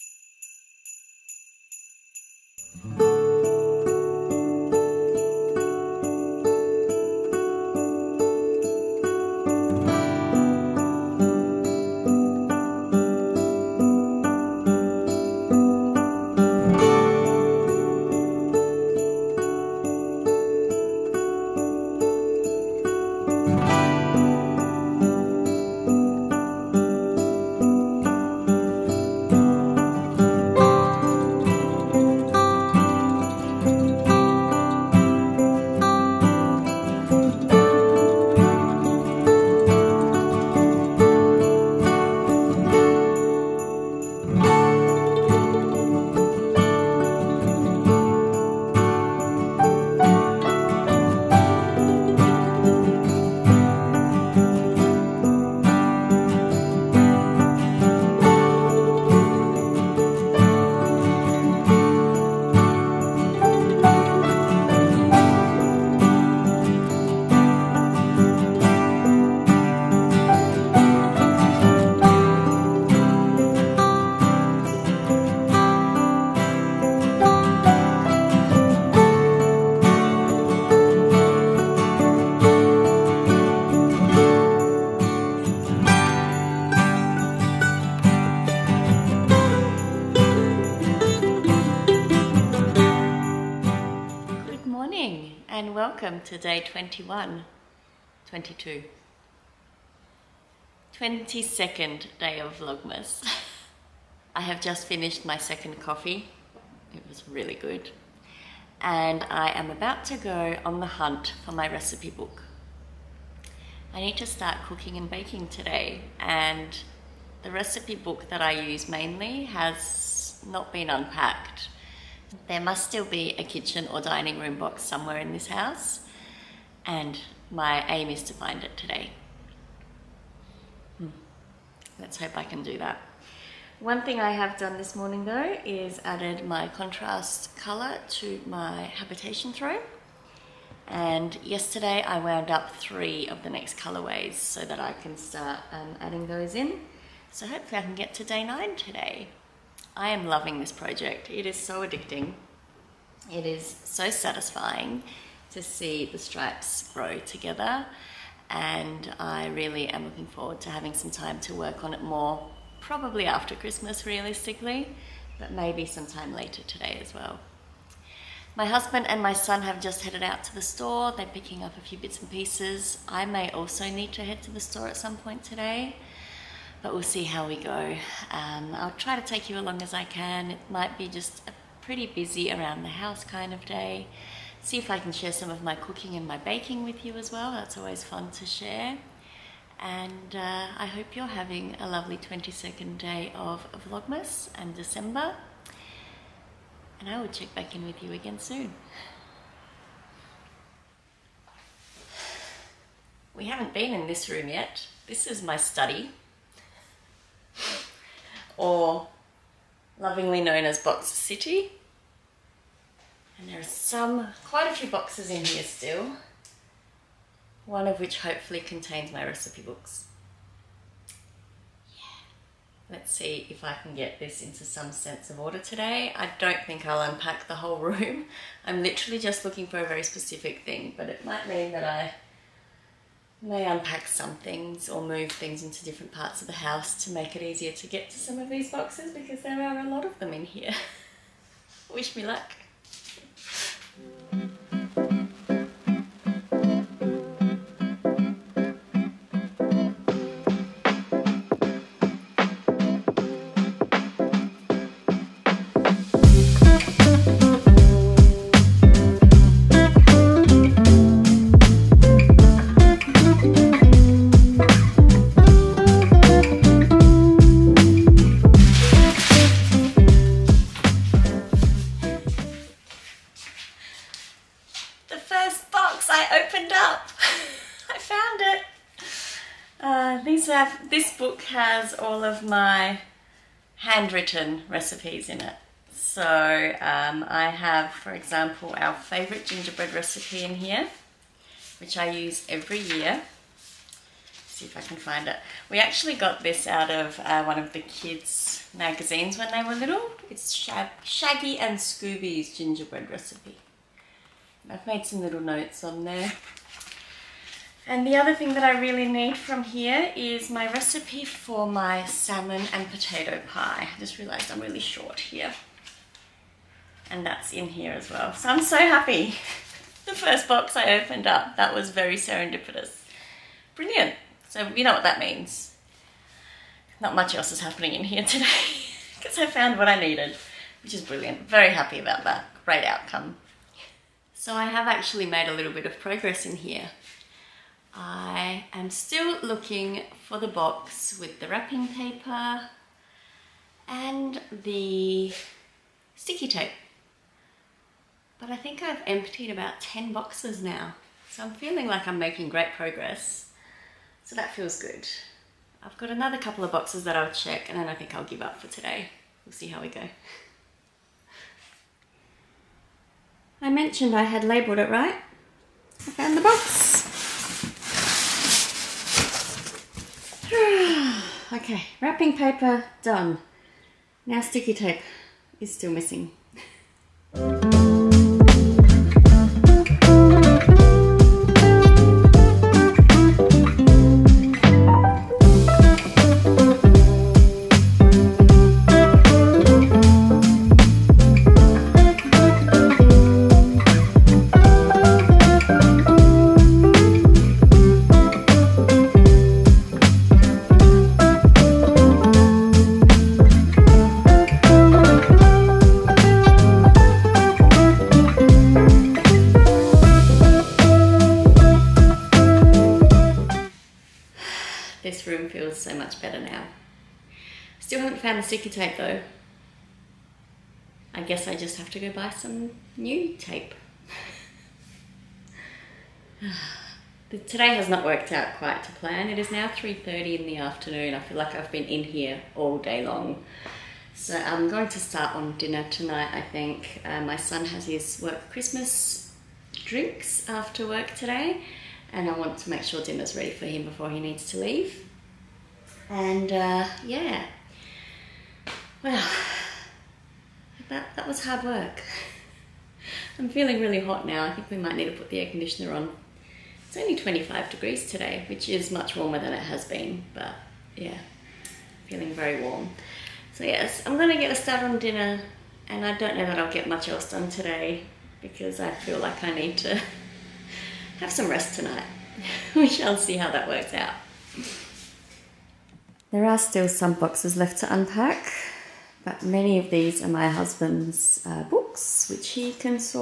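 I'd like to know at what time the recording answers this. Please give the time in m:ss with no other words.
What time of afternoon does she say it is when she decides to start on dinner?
7:09.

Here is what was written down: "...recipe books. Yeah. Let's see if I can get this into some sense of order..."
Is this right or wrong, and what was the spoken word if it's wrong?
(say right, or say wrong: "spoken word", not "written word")
right.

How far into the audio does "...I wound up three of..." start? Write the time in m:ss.
2:22.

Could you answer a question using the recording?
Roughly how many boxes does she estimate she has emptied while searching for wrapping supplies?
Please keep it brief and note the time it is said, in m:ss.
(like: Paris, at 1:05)
10, at 5:49.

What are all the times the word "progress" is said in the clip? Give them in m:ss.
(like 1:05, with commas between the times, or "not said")
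5:35, 5:52.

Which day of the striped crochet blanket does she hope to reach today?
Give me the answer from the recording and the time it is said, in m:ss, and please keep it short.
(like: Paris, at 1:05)
day 9, at 2:28.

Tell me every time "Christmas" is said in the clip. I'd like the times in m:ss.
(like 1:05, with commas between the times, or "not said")
2:43, 7:18.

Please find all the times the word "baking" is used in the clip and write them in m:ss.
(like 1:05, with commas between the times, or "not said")
1:55, 3:06.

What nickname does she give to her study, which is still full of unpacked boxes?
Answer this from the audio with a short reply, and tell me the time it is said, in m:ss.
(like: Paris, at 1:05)
Box City, at 3:30.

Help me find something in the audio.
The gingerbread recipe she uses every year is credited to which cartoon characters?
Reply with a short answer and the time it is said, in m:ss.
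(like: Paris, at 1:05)
Shaggy and Scooby, at 5:00.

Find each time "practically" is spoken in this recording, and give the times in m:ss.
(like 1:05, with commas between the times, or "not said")
not said.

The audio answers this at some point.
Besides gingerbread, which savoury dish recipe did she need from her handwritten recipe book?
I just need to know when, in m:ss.
5:12.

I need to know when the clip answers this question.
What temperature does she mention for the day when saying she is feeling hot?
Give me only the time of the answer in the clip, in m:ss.
7:37.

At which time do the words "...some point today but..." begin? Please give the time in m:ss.
2:54.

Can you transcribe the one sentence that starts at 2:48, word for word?
My husband and my son have just headed out to the store.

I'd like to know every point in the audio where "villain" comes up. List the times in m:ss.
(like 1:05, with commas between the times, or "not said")
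not said.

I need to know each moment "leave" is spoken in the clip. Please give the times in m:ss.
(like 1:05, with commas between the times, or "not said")
7:24.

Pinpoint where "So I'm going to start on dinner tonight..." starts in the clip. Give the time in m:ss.
7:14.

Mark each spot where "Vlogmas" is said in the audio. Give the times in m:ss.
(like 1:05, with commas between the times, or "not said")
1:42, 3:13.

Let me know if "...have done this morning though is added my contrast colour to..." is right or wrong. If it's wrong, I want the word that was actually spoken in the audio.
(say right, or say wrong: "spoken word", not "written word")
right.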